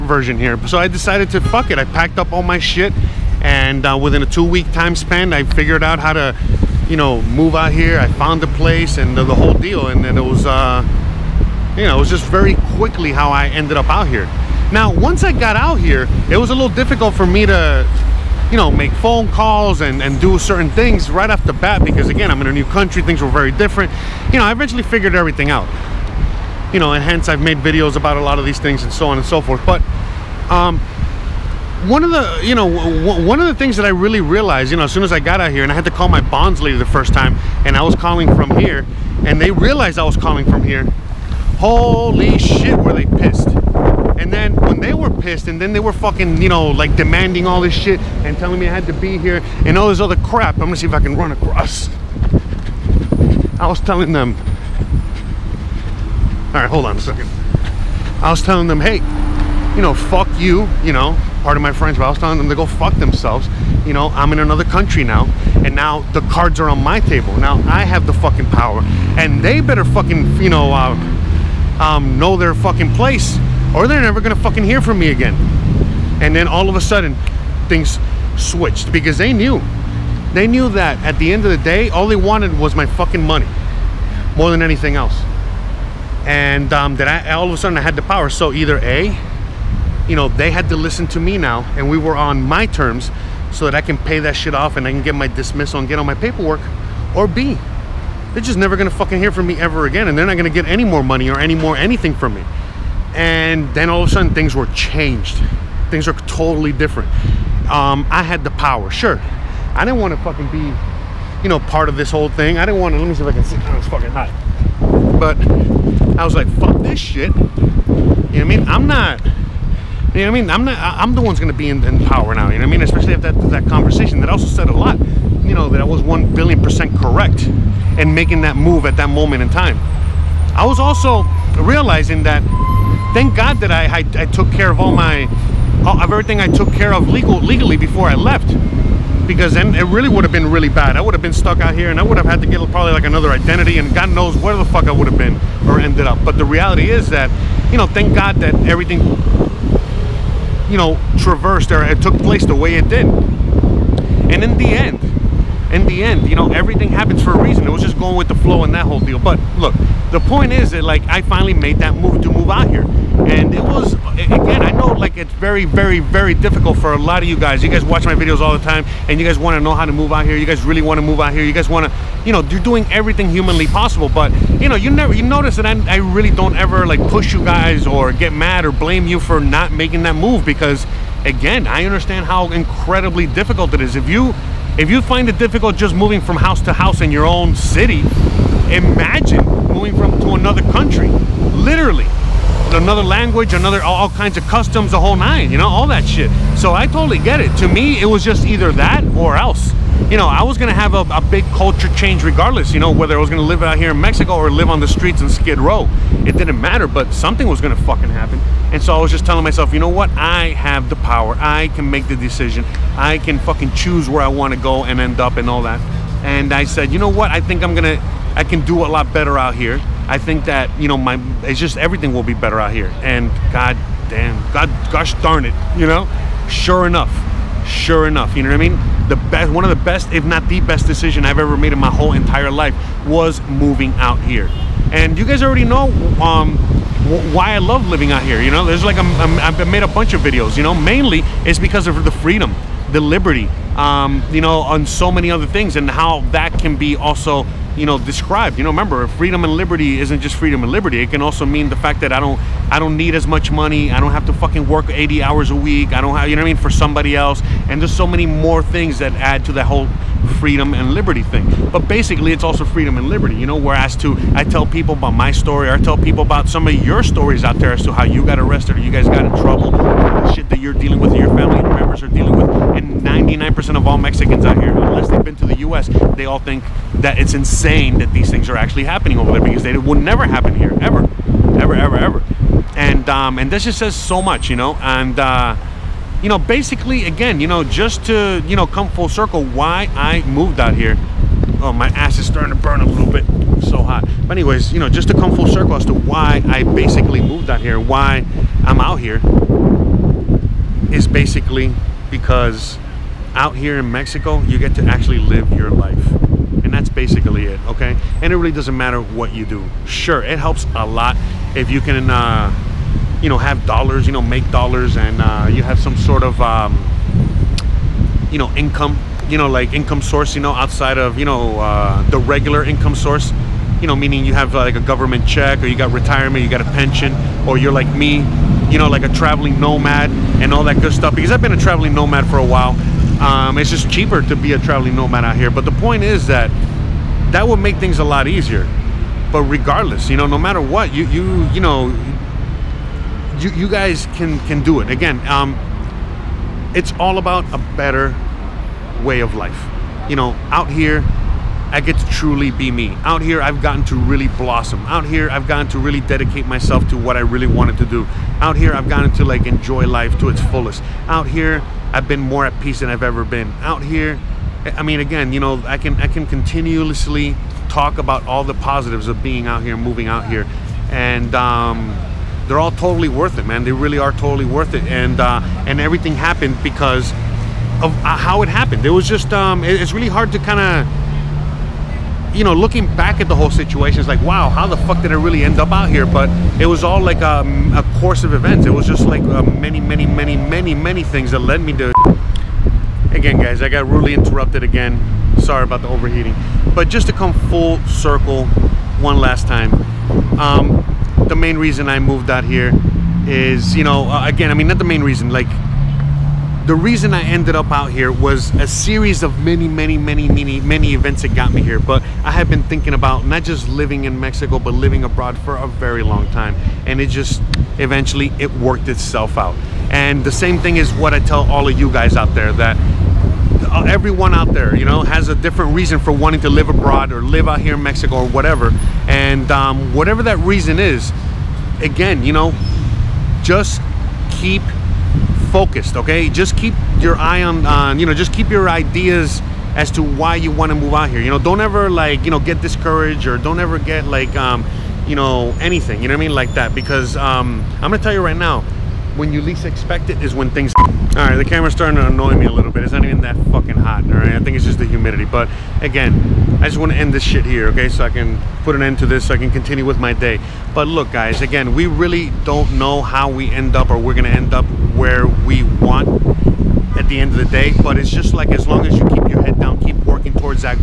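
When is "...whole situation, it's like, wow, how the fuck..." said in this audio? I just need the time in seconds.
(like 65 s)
383 s.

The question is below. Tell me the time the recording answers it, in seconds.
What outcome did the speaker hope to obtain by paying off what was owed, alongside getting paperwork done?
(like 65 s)
95 s.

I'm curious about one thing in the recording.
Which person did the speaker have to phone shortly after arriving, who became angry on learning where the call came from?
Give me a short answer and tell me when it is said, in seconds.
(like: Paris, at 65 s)
bonds lady, at 36 s.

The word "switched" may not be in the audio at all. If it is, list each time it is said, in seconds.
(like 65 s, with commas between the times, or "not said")
78 s.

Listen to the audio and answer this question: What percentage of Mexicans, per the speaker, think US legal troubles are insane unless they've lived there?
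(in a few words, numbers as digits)
99%.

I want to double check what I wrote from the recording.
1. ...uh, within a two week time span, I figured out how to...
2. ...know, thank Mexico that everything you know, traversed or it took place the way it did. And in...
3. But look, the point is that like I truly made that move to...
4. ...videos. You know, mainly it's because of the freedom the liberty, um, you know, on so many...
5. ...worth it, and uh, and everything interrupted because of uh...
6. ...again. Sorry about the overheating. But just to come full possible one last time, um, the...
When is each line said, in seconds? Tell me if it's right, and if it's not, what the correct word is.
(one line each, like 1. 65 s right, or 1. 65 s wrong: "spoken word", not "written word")
1. 3 s right
2. 147 s wrong: "God", not "Mexico"
3. 159 s wrong: "finally", not "truly"
4. 240 s right
5. 374 s wrong: "happened", not "interrupted"
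6. 394 s wrong: "circle", not "possible".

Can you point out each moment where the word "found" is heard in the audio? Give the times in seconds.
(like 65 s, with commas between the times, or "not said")
8 s.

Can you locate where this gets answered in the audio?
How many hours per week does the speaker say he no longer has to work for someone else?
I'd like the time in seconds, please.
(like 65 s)
254 s.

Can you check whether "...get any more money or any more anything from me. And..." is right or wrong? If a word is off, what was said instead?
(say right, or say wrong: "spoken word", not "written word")
right.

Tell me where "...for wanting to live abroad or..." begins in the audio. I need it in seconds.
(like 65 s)
425 s.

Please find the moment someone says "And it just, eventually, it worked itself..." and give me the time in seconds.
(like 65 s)
416 s.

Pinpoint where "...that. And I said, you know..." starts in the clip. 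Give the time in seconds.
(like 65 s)
215 s.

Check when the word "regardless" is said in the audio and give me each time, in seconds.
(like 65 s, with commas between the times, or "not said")
202 s, 339 s.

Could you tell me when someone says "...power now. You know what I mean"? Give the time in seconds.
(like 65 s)
122 s.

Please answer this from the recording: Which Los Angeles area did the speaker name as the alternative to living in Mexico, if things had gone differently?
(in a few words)
Skid Row.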